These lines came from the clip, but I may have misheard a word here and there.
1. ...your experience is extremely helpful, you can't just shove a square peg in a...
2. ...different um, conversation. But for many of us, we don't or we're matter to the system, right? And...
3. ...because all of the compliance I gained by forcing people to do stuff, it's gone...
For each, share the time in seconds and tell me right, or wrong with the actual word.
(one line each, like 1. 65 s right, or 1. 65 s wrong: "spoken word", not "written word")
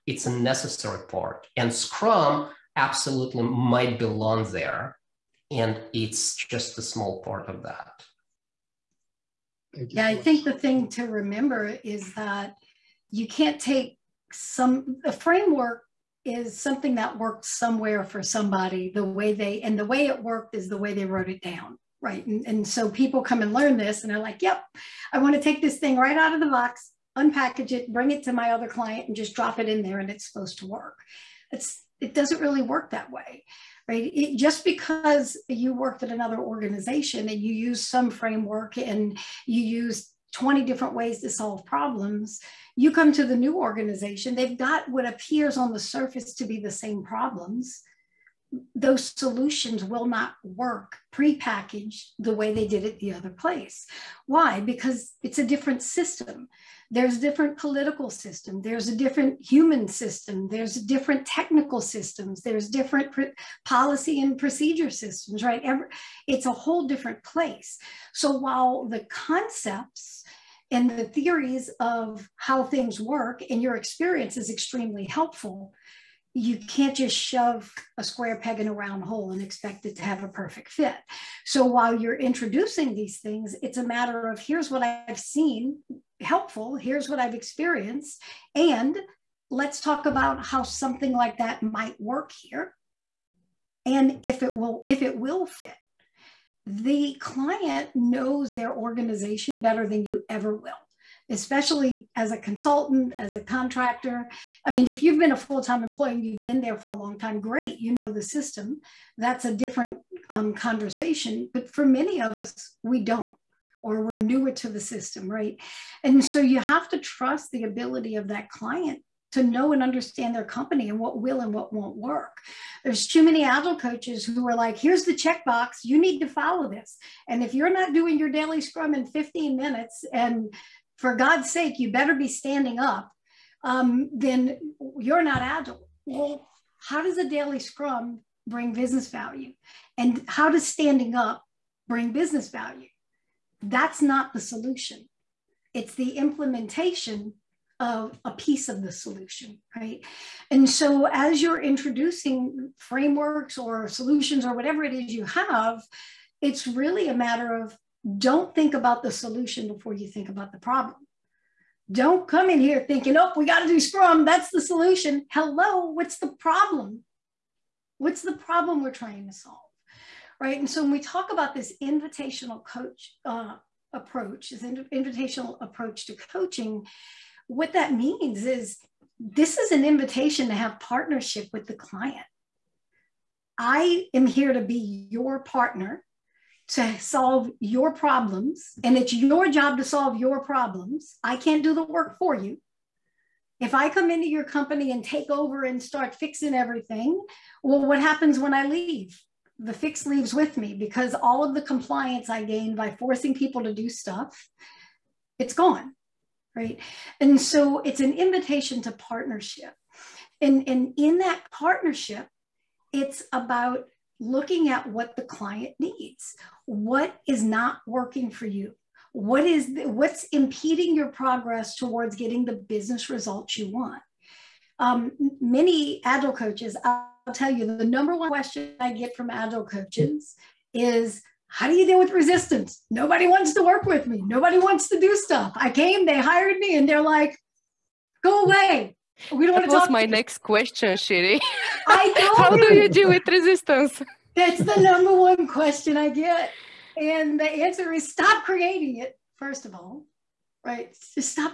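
1. 73 s right
2. 109 s wrong: "newer", not "matter"
3. 200 s right.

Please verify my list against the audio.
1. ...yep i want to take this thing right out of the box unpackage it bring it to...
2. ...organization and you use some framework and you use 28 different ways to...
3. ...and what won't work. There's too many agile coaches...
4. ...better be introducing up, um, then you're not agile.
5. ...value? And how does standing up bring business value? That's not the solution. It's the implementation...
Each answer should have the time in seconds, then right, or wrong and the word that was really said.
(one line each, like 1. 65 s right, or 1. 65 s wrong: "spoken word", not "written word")
1. 24 s right
2. 36 s wrong: "20", not "28"
3. 121 s right
4. 131 s wrong: "standing", not "introducing"
5. 139 s right.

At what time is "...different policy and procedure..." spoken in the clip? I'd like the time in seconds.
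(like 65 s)
62 s.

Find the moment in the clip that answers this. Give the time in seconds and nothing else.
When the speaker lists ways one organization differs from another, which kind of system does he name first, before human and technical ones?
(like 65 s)
57 s.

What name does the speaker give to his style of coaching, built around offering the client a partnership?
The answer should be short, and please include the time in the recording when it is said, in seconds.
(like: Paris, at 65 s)
invitational approach, at 174 s.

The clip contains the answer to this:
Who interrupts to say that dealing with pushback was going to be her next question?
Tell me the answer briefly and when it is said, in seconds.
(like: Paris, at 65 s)
Cherie, at 240 s.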